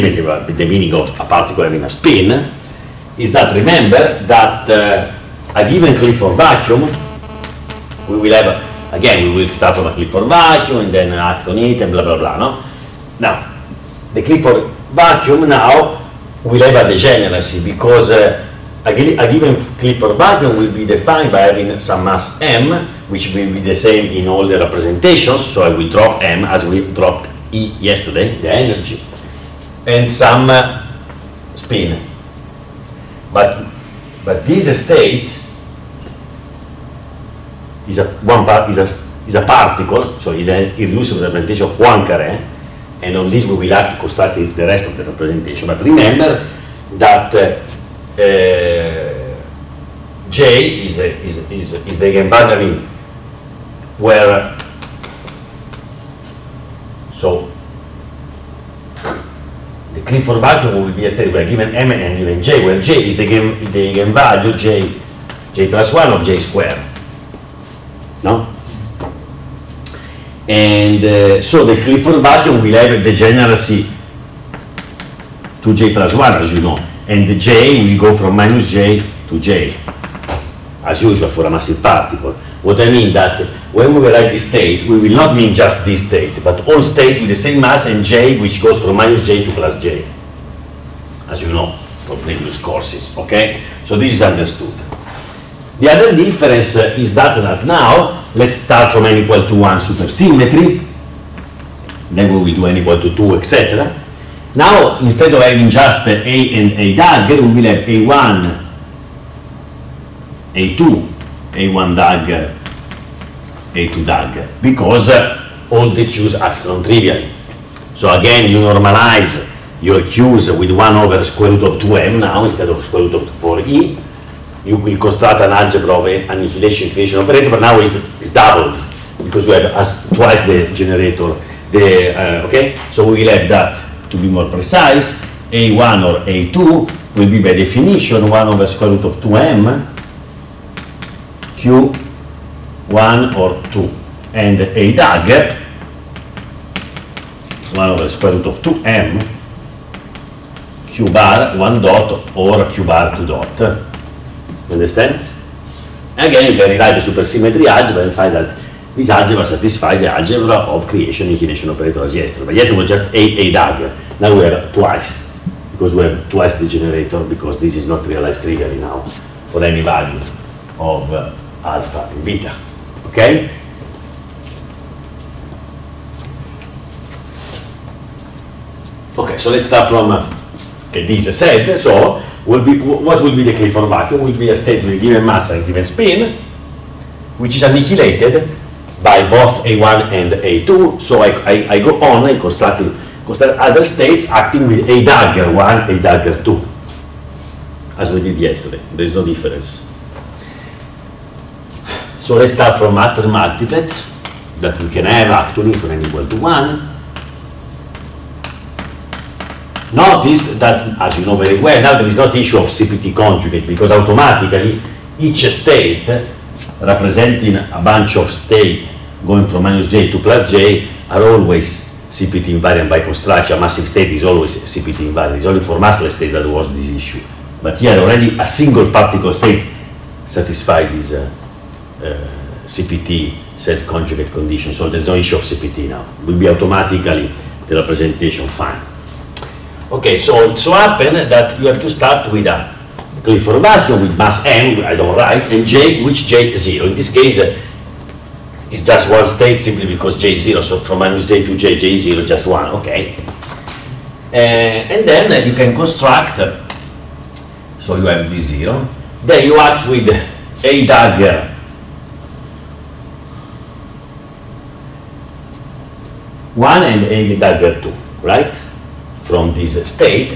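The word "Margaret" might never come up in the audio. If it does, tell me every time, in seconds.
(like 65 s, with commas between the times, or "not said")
not said.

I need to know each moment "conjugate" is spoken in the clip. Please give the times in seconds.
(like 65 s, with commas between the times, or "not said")
213 s, 233 s.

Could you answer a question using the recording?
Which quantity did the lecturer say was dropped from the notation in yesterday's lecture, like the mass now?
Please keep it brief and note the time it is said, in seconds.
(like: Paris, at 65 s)
The energy, at 27 s.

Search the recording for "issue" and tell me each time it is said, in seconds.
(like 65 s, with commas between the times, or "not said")
212 s, 226 s, 235 s.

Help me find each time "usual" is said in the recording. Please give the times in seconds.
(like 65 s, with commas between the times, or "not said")
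81 s.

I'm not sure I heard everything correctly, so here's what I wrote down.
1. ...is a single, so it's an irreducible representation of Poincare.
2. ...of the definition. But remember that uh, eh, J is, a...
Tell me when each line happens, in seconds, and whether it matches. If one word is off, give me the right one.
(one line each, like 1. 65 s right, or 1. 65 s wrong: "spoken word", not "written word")
1. 39 s wrong: "particle", not "single"
2. 44 s wrong: "representation", not "definition".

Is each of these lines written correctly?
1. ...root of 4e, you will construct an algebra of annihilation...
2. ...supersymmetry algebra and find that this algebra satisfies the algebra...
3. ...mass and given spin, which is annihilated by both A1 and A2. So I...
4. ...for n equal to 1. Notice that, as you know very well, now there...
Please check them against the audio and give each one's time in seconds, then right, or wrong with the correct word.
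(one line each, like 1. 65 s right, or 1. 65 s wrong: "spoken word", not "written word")
1. 123 s right
2. 157 s right
3. 185 s right
4. 205 s right.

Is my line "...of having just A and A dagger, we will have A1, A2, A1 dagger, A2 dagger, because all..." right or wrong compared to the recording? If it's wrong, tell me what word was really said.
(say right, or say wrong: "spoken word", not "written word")
right.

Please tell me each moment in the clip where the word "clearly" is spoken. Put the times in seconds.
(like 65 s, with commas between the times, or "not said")
168 s.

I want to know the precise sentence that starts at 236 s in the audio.
It will be automatically the representation fine.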